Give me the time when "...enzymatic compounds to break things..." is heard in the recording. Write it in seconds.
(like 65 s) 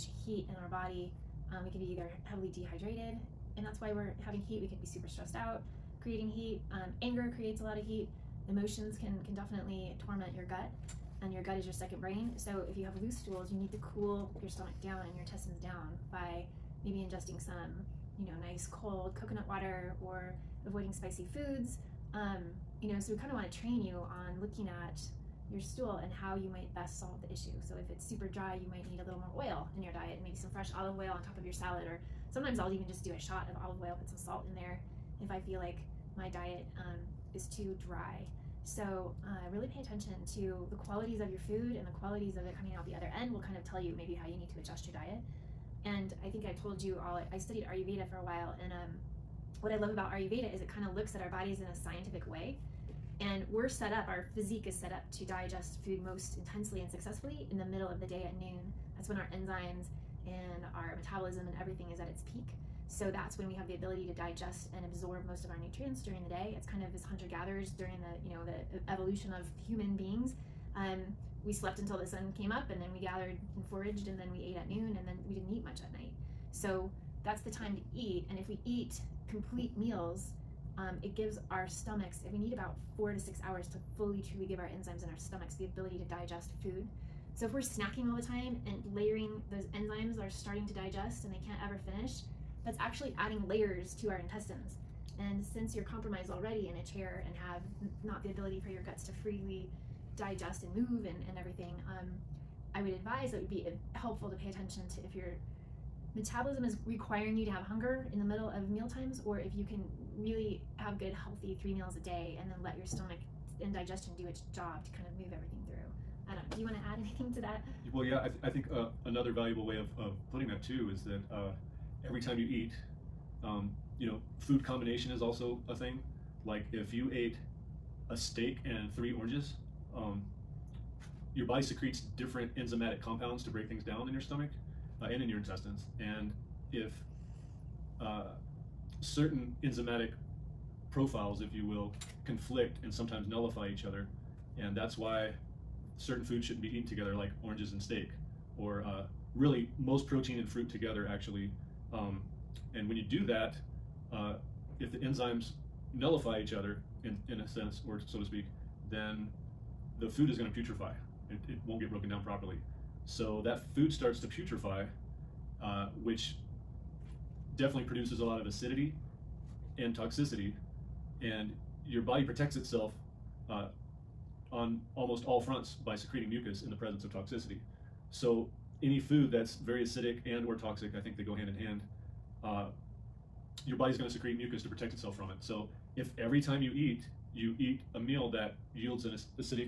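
132 s.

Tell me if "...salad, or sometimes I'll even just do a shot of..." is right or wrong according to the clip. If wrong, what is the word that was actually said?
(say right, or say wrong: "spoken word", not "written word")
right.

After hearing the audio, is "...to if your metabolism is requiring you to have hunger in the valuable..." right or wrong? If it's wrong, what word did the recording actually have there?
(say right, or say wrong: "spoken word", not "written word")
wrong: "middle", not "valuable".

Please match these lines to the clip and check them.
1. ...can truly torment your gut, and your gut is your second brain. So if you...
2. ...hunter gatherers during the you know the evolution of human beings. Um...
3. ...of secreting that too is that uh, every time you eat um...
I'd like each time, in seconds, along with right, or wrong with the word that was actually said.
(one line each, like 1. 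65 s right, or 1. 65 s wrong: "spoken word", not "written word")
1. 9 s wrong: "definitely", not "truly"
2. 67 s right
3. 119 s wrong: "putting", not "secreting".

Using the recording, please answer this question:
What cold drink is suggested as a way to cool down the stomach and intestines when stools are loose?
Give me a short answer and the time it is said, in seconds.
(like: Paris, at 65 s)
coconut water, at 19 s.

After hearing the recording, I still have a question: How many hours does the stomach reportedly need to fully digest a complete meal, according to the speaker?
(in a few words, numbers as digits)
4 to 6 hours.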